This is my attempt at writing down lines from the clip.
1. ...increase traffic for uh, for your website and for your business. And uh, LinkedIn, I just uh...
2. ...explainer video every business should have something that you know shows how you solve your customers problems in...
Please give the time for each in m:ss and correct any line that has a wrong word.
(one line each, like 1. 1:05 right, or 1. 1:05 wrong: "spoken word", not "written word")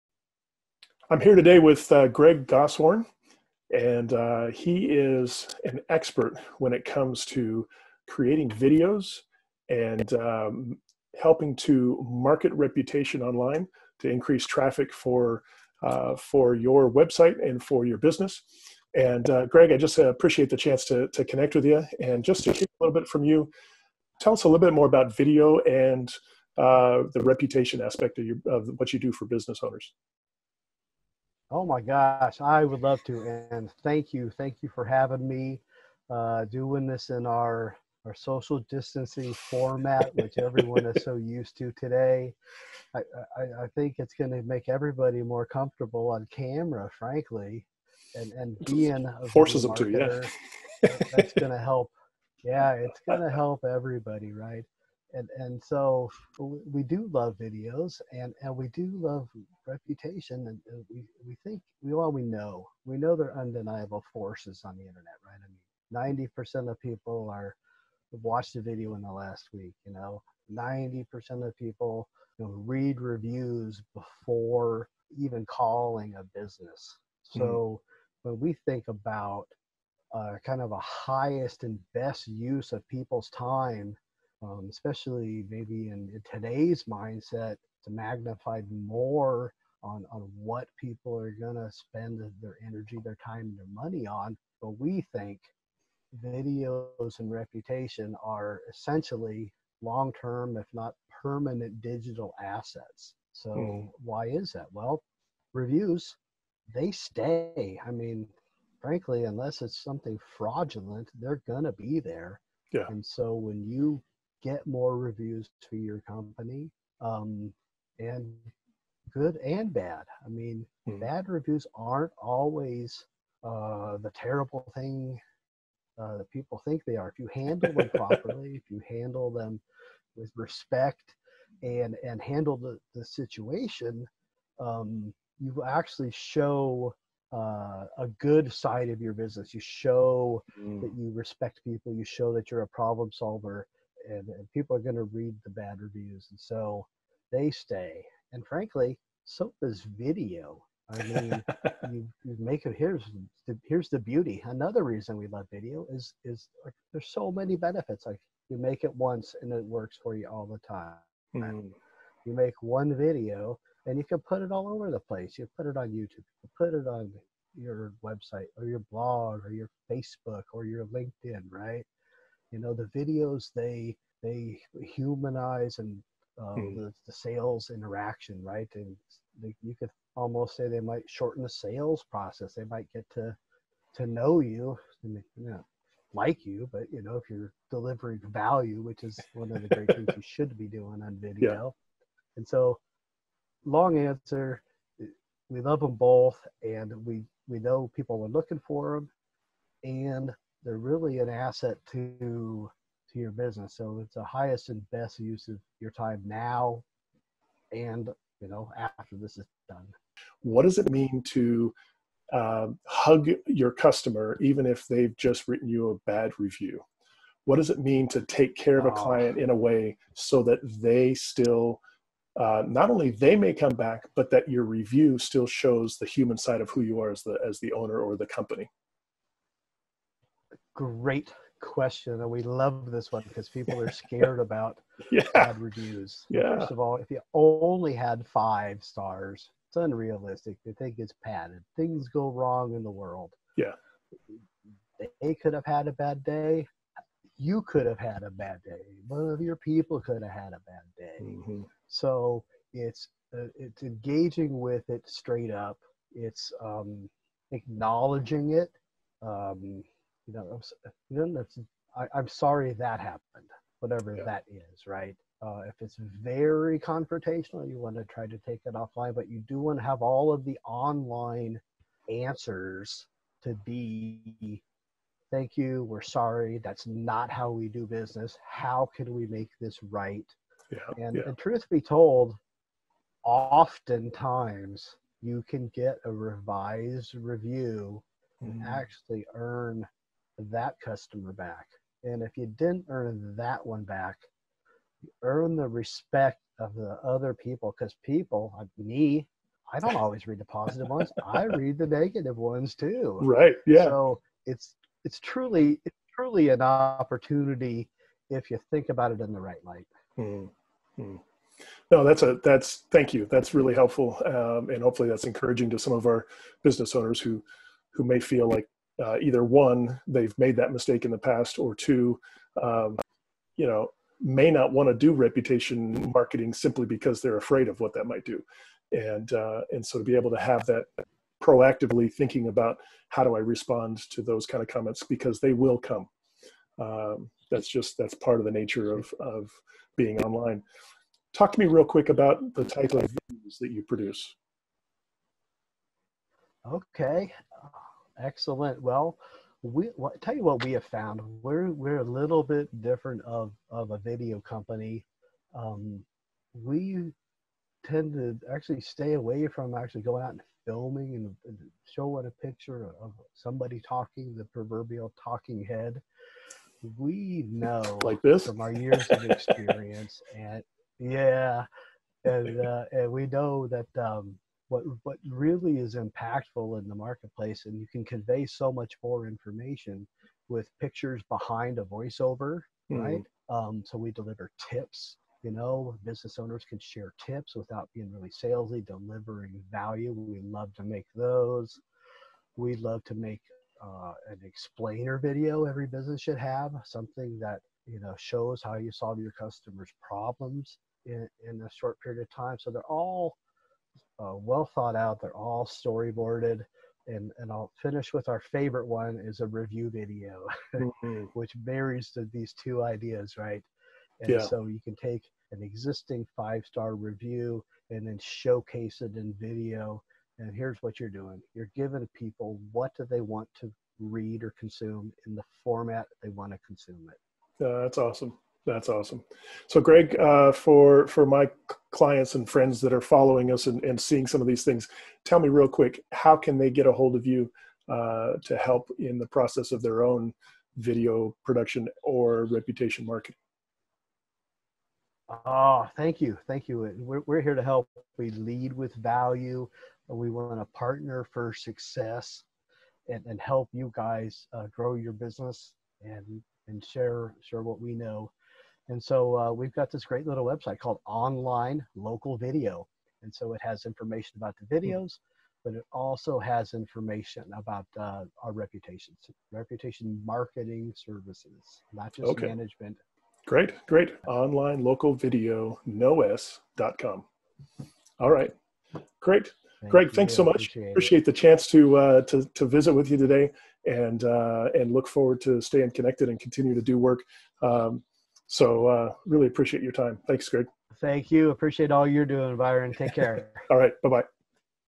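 1. 0:14 wrong: "Greg", not "LinkedIn"
2. 6:34 right.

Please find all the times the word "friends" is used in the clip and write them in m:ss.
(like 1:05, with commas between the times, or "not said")
7:12.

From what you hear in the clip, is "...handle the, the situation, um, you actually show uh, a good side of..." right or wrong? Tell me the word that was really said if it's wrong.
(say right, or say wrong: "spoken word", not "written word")
right.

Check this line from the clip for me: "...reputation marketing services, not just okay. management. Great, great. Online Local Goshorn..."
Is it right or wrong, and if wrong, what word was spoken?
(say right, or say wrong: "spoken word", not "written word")
wrong: "Video", not "Goshorn".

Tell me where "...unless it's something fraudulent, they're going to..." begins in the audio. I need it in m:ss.
1:49.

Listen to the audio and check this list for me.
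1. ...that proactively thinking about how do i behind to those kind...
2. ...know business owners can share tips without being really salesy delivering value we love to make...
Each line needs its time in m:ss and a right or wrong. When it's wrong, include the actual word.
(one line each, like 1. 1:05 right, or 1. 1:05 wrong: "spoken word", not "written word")
1. 5:30 wrong: "respond", not "behind"
2. 6:25 right.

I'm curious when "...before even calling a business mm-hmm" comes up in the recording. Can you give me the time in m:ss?
1:13.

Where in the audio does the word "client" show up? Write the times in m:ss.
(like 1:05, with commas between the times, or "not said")
3:38, 7:11.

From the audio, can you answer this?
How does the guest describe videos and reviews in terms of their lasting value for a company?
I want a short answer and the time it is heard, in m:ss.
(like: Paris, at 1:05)
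digital assets, at 1:41.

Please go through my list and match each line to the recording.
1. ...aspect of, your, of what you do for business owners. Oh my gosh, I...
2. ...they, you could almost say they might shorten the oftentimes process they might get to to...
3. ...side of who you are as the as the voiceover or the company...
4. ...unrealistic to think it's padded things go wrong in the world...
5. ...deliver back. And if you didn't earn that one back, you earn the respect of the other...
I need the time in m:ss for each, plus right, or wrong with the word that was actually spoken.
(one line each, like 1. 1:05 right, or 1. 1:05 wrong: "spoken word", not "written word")
1. 0:27 right
2. 2:59 wrong: "sales", not "oftentimes"
3. 3:46 wrong: "owner", not "voiceover"
4. 3:59 right
5. 4:50 wrong: "customer", not "deliver".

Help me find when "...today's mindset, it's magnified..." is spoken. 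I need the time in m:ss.
1:26.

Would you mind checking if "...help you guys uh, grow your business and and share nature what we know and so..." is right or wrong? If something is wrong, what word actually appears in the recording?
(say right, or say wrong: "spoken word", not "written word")
wrong: "share", not "nature".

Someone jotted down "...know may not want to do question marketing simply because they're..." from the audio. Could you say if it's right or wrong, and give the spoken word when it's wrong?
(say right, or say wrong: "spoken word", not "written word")
wrong: "reputation", not "question".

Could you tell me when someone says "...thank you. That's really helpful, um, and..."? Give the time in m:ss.
5:12.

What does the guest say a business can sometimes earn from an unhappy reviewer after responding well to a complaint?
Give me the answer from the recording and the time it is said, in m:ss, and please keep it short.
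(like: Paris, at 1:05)
a revised review, at 4:46.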